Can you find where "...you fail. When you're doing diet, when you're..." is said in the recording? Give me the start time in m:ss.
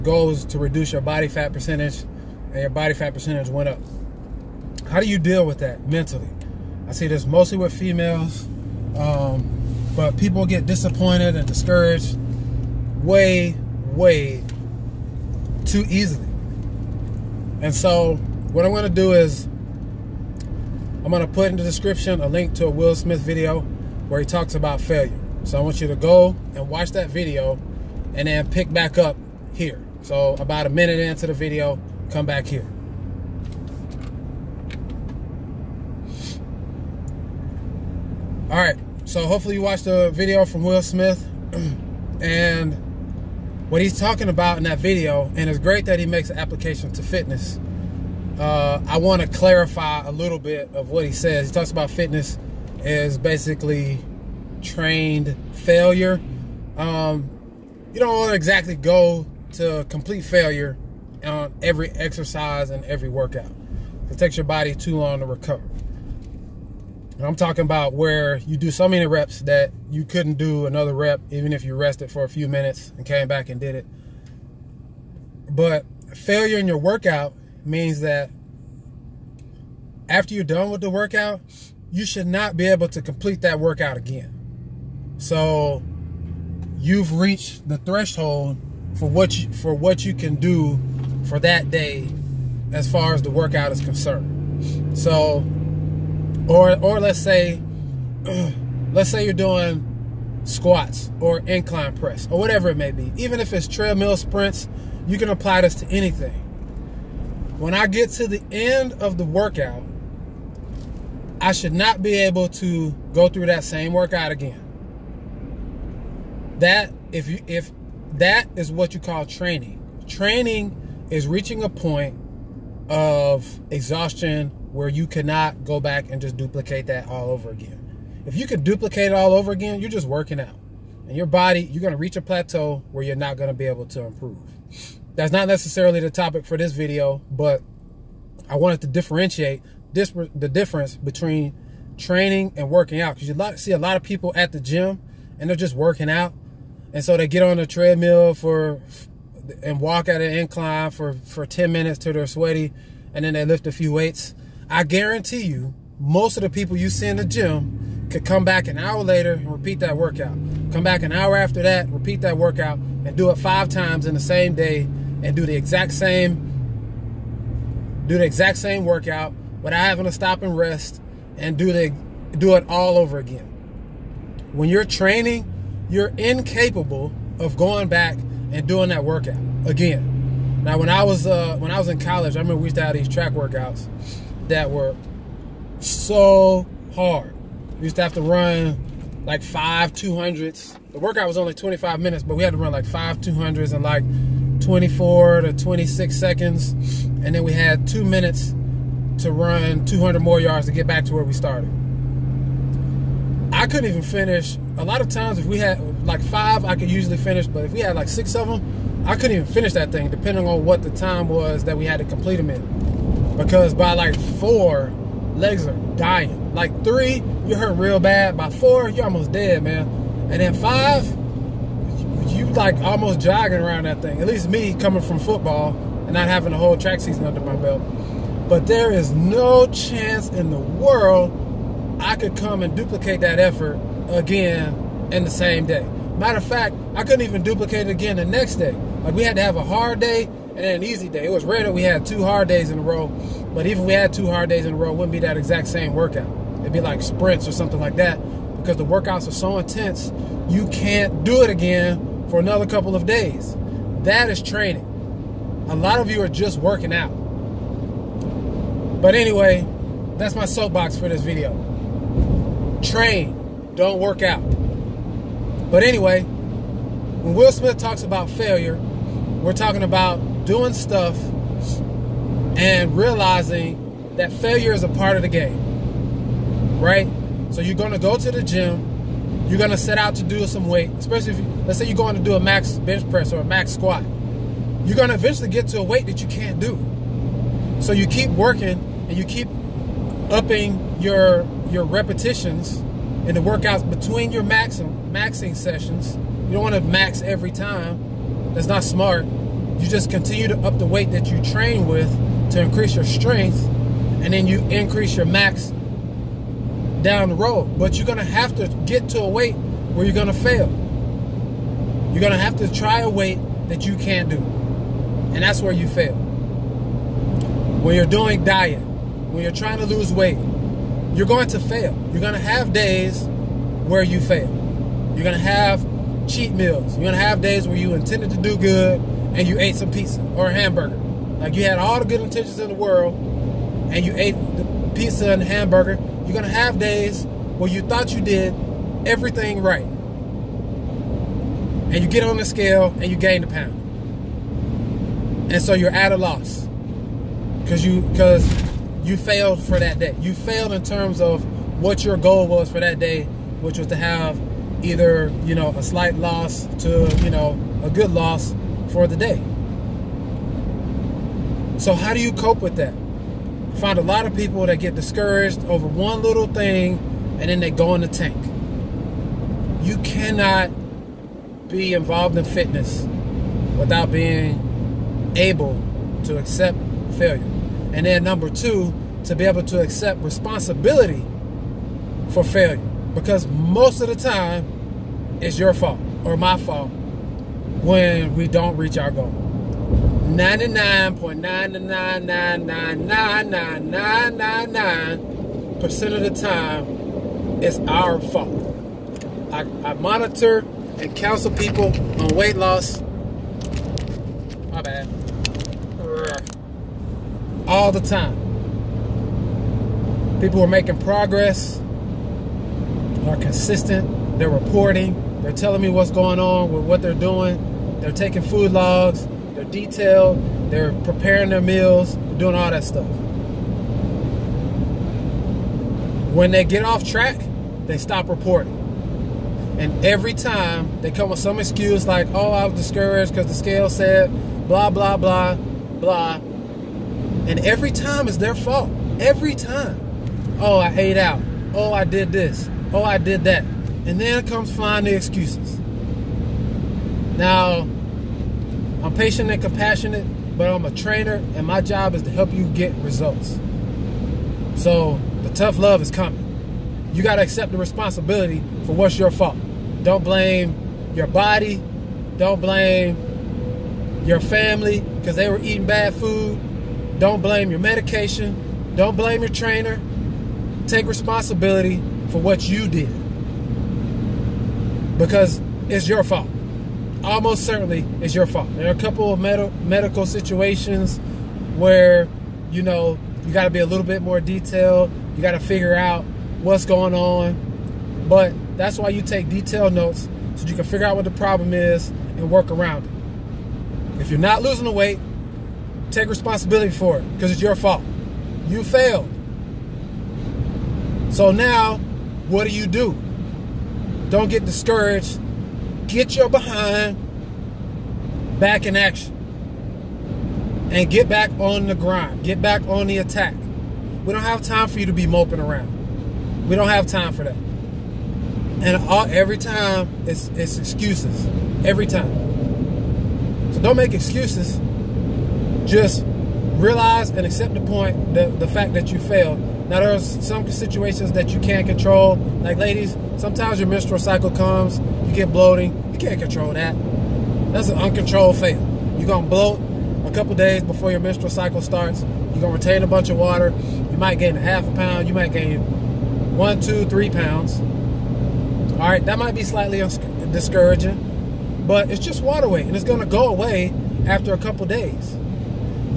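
5:15.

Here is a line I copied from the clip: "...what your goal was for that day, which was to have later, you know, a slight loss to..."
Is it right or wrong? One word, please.
wrong.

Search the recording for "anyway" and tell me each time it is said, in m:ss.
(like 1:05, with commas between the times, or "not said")
4:19, 4:25.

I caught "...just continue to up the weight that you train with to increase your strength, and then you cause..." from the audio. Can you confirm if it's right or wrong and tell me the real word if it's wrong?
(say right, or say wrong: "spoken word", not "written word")
wrong: "increase", not "cause".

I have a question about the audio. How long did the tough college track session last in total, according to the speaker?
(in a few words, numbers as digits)
25 minutes.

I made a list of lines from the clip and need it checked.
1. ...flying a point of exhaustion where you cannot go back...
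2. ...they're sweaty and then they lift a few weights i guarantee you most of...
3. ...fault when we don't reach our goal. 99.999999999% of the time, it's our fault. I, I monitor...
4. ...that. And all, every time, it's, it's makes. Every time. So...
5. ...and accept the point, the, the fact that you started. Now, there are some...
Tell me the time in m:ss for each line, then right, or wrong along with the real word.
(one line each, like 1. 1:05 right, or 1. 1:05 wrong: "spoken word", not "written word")
1. 2:01 wrong: "reaching", not "flying"
2. 2:32 right
3. 6:26 right
4. 8:37 wrong: "excuses", not "makes"
5. 8:47 wrong: "failed", not "started".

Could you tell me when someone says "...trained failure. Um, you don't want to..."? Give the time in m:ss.
0:54.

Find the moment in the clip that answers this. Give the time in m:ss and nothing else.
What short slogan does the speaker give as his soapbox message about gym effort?
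4:22.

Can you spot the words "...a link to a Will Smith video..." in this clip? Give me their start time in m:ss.
0:22.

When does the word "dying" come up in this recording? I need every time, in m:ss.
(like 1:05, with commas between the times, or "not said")
3:35.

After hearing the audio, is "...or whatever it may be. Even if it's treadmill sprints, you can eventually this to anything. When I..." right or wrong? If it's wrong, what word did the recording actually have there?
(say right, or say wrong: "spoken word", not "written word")
wrong: "apply", not "eventually".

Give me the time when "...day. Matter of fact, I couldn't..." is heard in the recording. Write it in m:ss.
3:55.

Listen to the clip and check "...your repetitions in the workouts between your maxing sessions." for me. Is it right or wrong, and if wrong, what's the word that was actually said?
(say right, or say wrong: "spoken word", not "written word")
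right.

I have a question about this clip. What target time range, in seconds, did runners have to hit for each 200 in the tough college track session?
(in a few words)
24 to 26 seconds.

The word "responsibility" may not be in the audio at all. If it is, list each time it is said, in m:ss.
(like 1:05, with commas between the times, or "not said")
6:20, 7:37, 7:51, 8:16.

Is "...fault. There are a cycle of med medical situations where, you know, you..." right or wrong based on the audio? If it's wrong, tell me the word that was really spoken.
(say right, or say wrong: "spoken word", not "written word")
wrong: "couple", not "cycle".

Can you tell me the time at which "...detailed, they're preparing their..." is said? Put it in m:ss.
6:59.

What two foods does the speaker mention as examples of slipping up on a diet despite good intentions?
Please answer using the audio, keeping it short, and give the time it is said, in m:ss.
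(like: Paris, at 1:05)
pizza or a hamburger, at 5:29.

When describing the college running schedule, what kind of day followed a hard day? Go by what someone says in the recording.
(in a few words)
an easy day.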